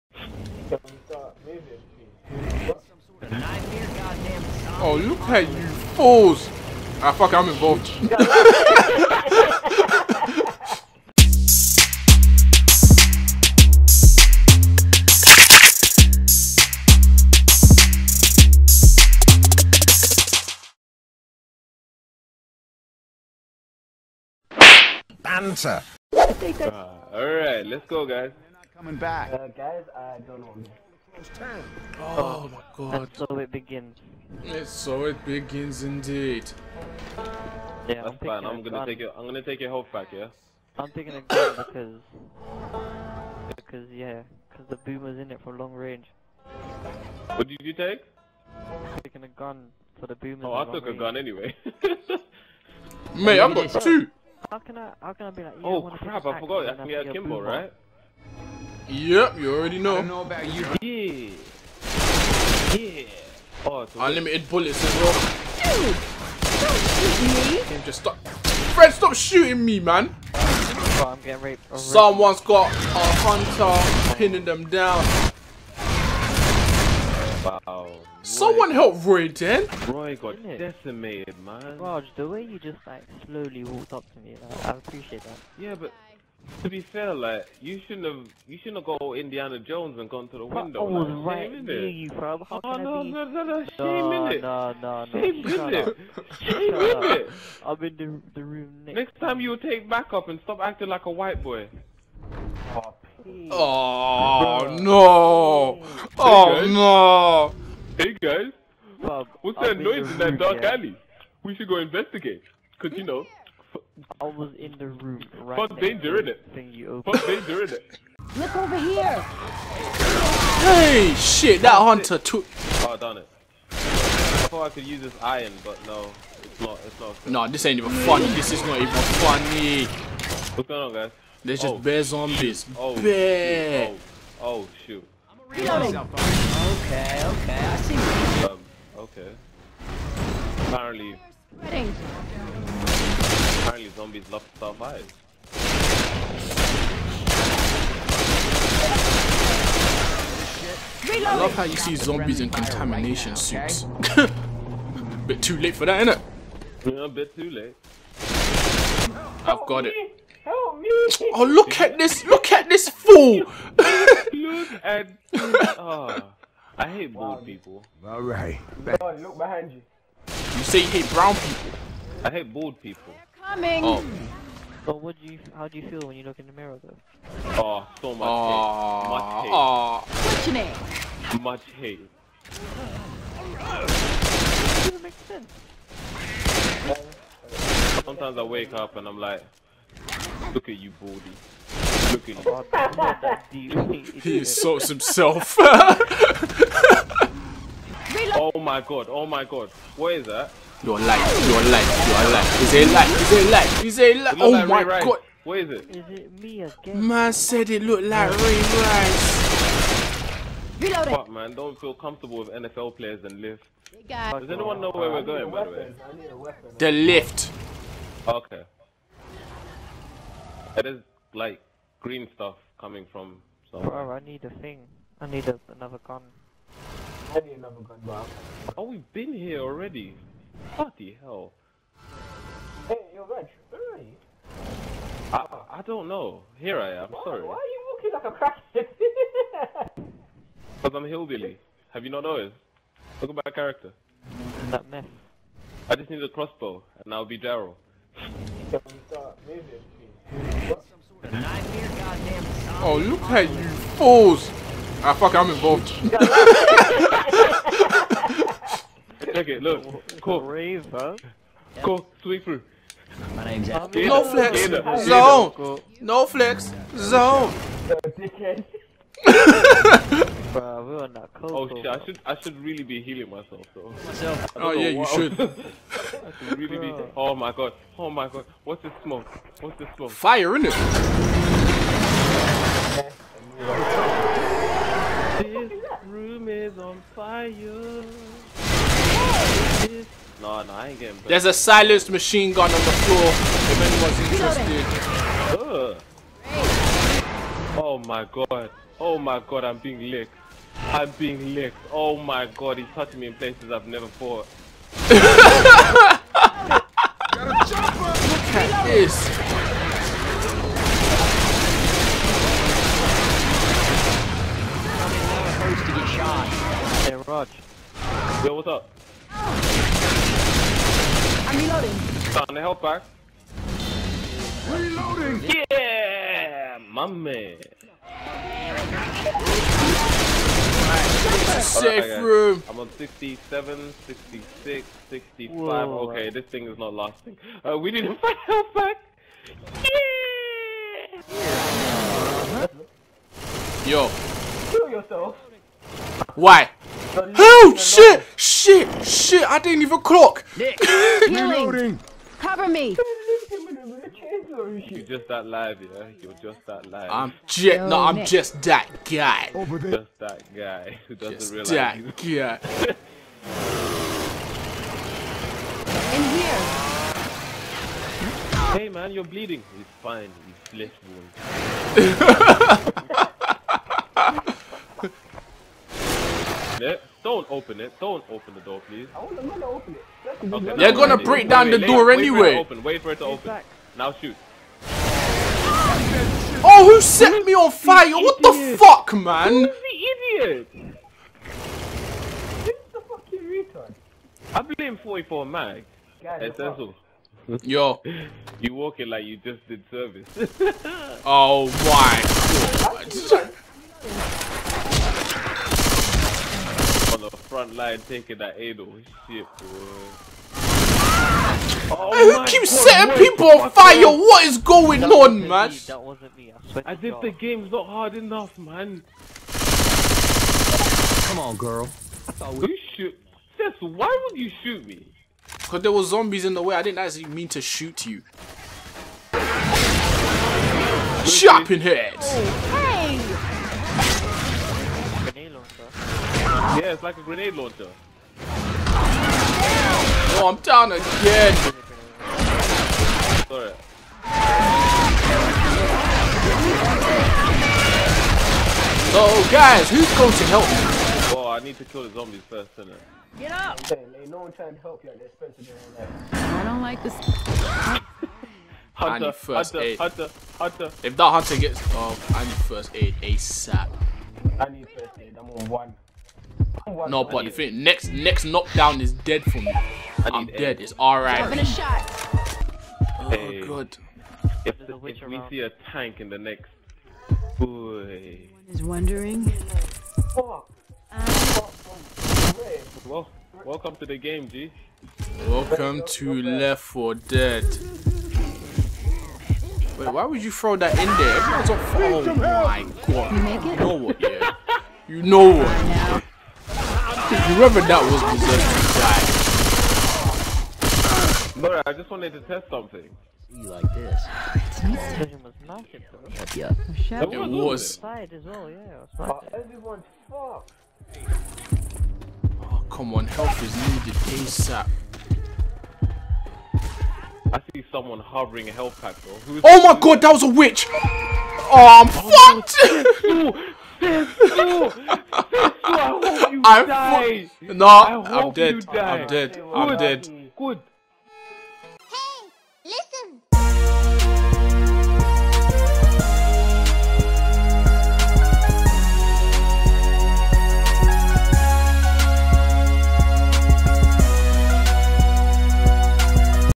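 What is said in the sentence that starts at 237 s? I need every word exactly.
Why are you walking like a crackhead?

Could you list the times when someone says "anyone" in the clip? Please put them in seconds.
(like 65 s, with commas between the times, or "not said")
214 s, 293 s.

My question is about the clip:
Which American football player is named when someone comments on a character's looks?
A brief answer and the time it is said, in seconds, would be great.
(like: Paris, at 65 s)
Ray Rice, at 208 s.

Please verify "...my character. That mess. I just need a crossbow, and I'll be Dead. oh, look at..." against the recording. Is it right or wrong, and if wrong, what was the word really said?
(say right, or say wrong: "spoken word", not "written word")
wrong: "Daryl", not "Dead".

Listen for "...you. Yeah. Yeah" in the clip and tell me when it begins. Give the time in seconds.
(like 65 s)
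60 s.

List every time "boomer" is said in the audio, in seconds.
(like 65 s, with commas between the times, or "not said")
44 s, 50 s.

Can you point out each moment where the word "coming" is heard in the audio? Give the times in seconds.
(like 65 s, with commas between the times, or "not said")
28 s, 173 s, 222 s.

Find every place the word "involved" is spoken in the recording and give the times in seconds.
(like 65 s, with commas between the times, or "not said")
7 s, 255 s.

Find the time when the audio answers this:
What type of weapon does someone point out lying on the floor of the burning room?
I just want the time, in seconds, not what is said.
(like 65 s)
291 s.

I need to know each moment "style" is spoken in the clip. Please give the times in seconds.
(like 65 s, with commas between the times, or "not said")
not said.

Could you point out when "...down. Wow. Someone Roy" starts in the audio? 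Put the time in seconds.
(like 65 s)
74 s.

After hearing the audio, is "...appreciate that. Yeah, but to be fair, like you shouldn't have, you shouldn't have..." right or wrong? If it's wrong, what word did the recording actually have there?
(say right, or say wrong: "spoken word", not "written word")
right.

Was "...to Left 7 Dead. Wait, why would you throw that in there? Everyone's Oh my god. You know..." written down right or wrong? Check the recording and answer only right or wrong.
wrong.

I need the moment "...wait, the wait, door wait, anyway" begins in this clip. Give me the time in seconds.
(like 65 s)
381 s.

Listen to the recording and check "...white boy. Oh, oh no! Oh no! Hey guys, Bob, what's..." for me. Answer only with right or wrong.
right.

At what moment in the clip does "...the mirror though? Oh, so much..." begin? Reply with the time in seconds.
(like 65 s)
176 s.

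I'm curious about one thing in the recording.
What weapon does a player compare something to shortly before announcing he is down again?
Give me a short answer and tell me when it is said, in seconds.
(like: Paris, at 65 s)
Grenade launcher, at 437 s.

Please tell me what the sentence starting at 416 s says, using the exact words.
I, I did the game's not hard enough, man.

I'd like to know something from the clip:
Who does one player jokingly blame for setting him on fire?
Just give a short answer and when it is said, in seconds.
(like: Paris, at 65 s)
44 Mag, at 394 s.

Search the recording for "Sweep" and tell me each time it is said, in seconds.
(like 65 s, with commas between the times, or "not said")
262 s.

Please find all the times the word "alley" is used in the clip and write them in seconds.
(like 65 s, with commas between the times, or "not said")
110 s.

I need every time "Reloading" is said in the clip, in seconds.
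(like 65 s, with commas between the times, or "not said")
135 s, 210 s, 324 s, 350 s.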